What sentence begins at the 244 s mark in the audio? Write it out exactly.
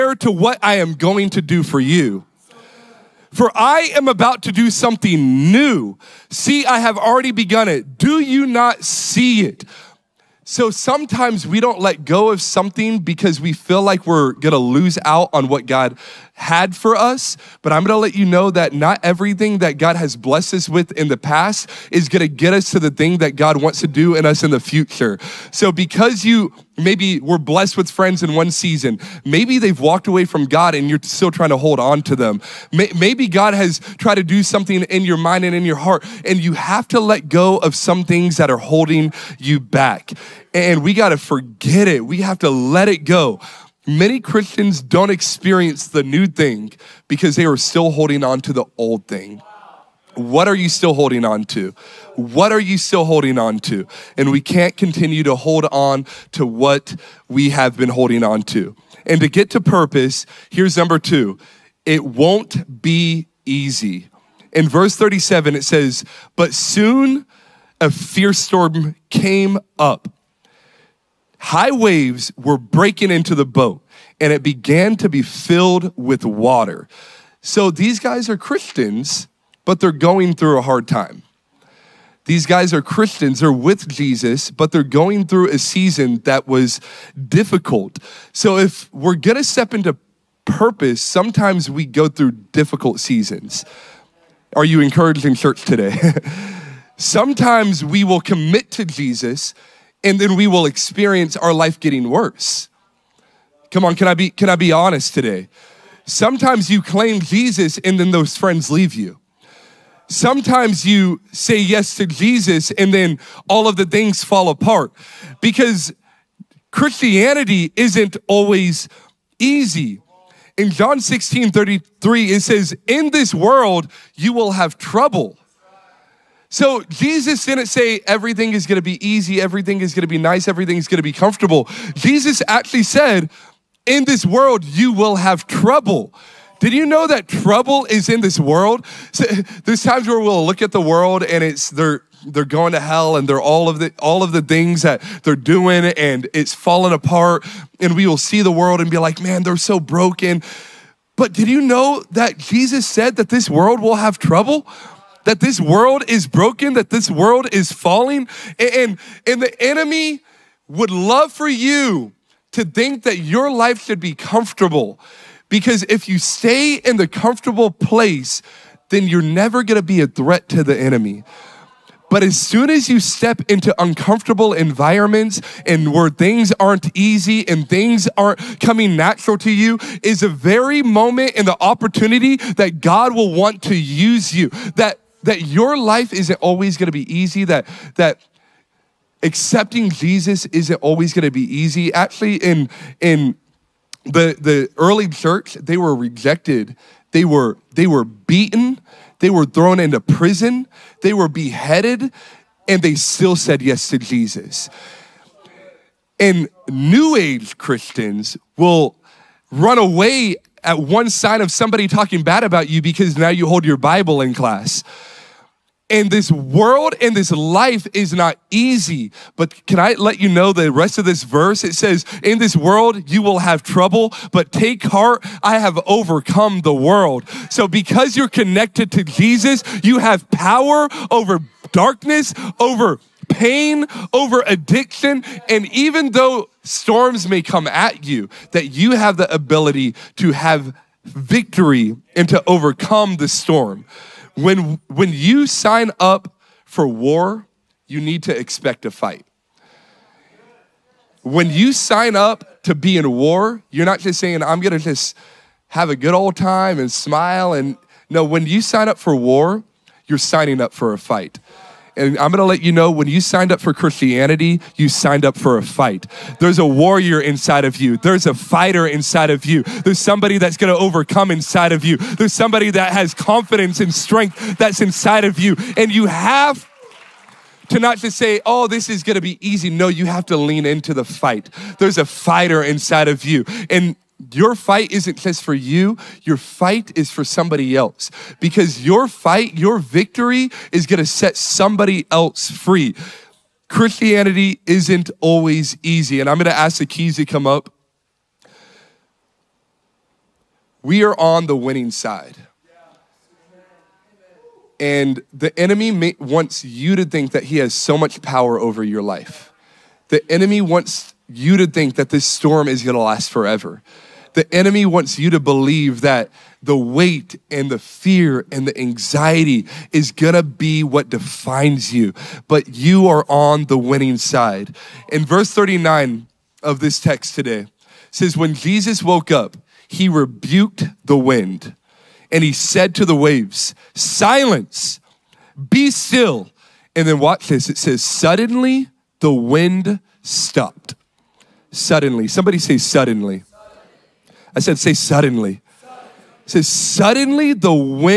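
When, when you sign up for war, you need to expect a fight.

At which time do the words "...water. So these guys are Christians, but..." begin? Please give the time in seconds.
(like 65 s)
76 s.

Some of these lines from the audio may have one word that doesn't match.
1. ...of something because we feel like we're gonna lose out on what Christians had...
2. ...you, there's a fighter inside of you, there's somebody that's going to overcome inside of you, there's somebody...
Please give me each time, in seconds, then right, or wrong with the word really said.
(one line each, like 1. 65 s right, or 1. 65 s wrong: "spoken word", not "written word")
1. 12 s wrong: "God", not "Christians"
2. 267 s right.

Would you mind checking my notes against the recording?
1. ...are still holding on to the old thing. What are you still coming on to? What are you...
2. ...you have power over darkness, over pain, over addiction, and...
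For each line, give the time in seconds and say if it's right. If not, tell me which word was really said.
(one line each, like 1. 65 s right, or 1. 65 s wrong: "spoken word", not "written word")
1. 47 s wrong: "holding", not "coming"
2. 229 s right.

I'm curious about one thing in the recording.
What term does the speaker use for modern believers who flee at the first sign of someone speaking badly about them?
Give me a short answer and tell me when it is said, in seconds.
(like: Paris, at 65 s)
New Age Christians, at 206 s.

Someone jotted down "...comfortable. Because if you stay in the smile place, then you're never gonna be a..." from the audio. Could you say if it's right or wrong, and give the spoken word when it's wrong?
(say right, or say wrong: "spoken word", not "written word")
wrong: "comfortable", not "smile".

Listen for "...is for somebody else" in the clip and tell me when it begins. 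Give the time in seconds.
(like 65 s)
286 s.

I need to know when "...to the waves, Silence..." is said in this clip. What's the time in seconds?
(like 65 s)
332 s.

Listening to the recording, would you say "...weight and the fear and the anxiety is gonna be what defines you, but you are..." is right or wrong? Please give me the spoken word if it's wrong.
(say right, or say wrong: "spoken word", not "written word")
right.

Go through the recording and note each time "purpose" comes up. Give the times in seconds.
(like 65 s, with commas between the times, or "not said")
59 s, 90 s.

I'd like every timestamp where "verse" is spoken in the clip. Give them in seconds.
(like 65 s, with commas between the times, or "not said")
64 s, 221 s, 325 s.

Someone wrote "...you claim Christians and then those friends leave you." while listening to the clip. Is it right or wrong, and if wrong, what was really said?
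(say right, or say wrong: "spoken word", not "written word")
wrong: "Jesus", not "Christians".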